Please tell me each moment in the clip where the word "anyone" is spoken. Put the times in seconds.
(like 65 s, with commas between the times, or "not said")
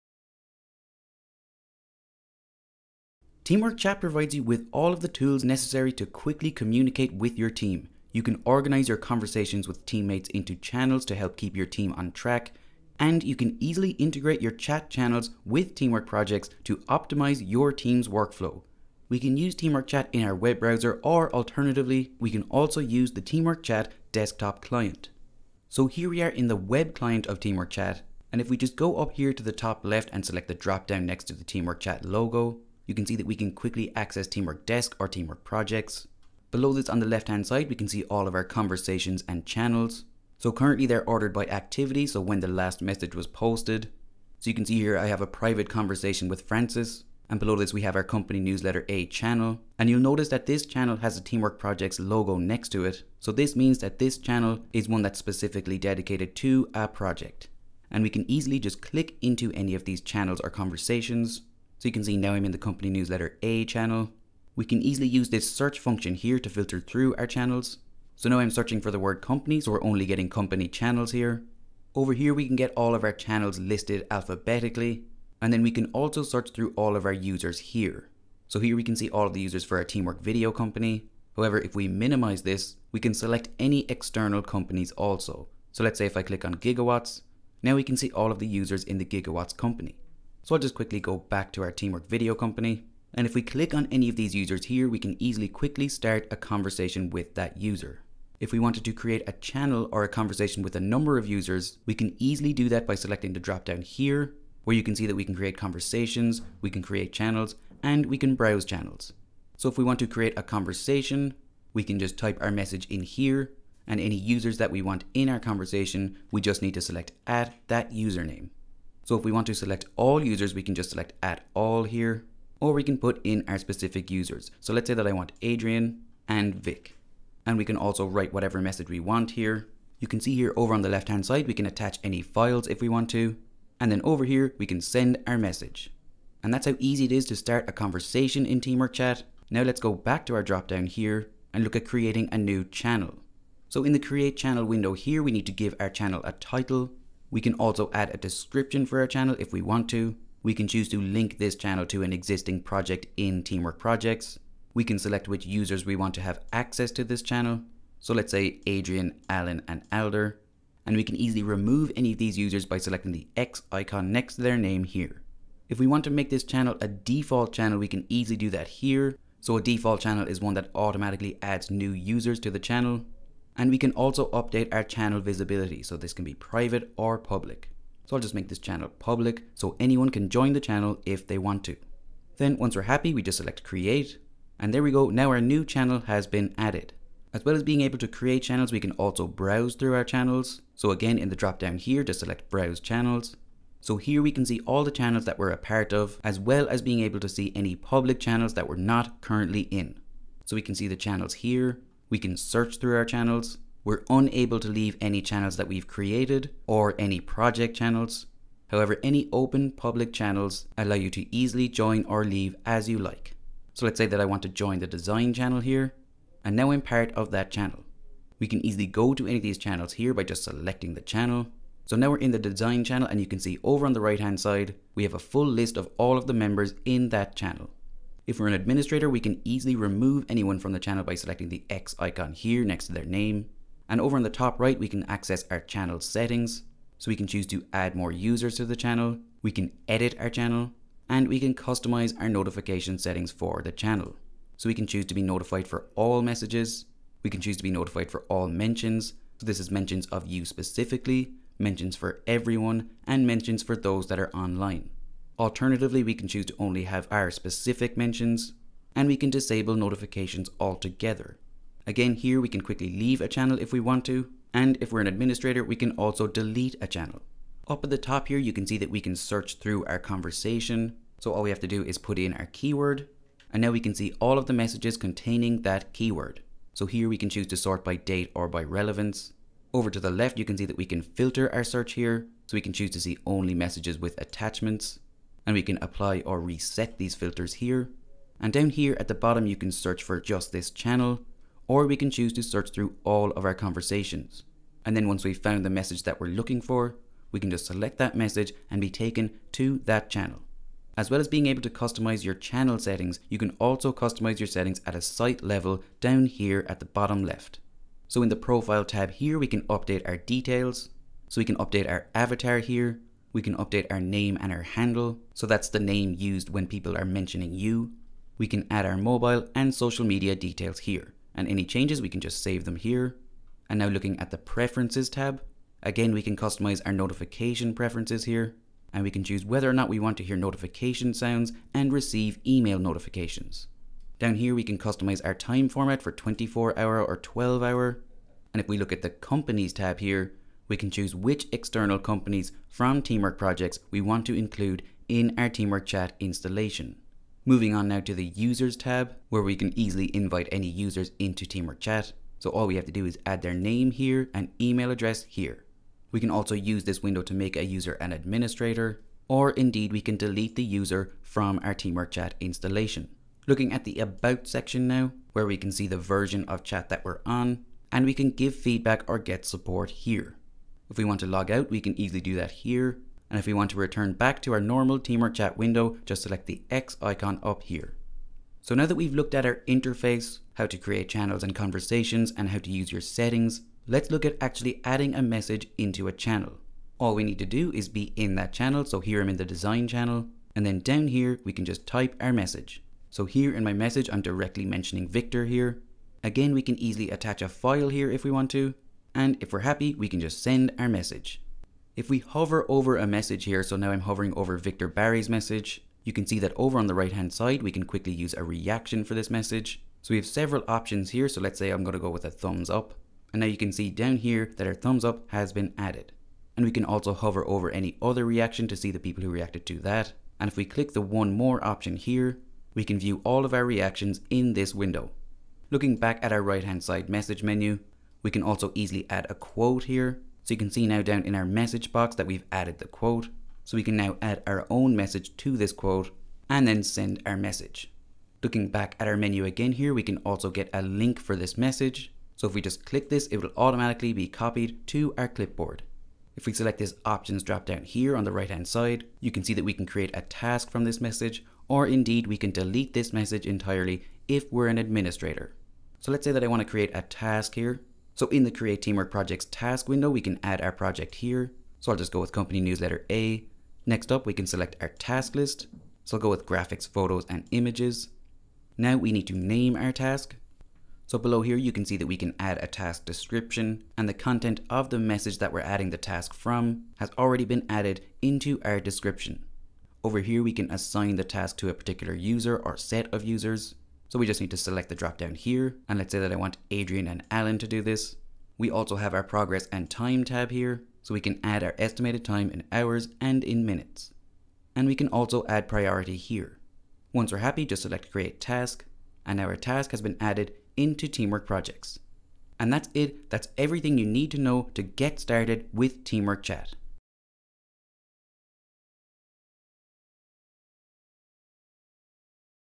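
179 s, 230 s.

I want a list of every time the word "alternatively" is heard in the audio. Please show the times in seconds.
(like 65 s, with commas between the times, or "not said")
21 s, 255 s.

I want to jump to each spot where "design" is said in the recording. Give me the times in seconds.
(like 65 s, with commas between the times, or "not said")
214 s, 222 s, 389 s.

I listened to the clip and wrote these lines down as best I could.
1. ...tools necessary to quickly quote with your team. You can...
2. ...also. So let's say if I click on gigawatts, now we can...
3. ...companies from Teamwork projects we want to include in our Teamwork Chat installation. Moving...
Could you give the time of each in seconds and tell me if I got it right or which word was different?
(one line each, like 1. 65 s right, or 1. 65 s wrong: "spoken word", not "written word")
1. 5 s wrong: "communicate", not "quote"
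2. 84 s right
3. 341 s right.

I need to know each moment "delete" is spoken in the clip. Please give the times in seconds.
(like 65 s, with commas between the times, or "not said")
266 s, 360 s, 452 s.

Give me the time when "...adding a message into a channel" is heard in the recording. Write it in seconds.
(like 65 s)
384 s.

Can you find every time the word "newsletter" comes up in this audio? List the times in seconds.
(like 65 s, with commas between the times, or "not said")
48 s, 62 s, 462 s.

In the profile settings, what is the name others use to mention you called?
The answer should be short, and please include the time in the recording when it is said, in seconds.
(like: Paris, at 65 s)
Handle, at 314 s.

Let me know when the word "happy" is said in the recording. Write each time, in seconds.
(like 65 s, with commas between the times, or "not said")
182 s, 399 s, 497 s.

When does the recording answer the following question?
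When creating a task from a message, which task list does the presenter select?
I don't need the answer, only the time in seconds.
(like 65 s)
466 s.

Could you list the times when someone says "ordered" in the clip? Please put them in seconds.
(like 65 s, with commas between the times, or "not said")
41 s.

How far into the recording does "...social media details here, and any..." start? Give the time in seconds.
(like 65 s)
319 s.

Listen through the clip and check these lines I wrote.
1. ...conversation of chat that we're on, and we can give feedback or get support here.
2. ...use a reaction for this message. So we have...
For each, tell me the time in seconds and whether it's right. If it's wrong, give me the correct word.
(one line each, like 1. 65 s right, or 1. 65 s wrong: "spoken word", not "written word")
1. 365 s wrong: "version", not "conversation"
2. 408 s right.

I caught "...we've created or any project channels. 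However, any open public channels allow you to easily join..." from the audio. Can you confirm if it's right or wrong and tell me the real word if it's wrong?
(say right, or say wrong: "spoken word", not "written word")
right.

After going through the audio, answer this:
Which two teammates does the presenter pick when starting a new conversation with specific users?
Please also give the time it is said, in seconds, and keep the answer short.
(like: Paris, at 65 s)
Adrian and Vic, at 125 s.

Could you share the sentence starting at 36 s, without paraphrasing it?
Below this on the left hand side, we can see all of our conversations and channels.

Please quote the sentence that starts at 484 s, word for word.
So we just need to select the drop down here.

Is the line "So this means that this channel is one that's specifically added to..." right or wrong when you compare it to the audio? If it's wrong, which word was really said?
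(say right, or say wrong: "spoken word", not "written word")
wrong: "dedicated", not "added".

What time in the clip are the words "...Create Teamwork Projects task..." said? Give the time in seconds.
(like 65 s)
458 s.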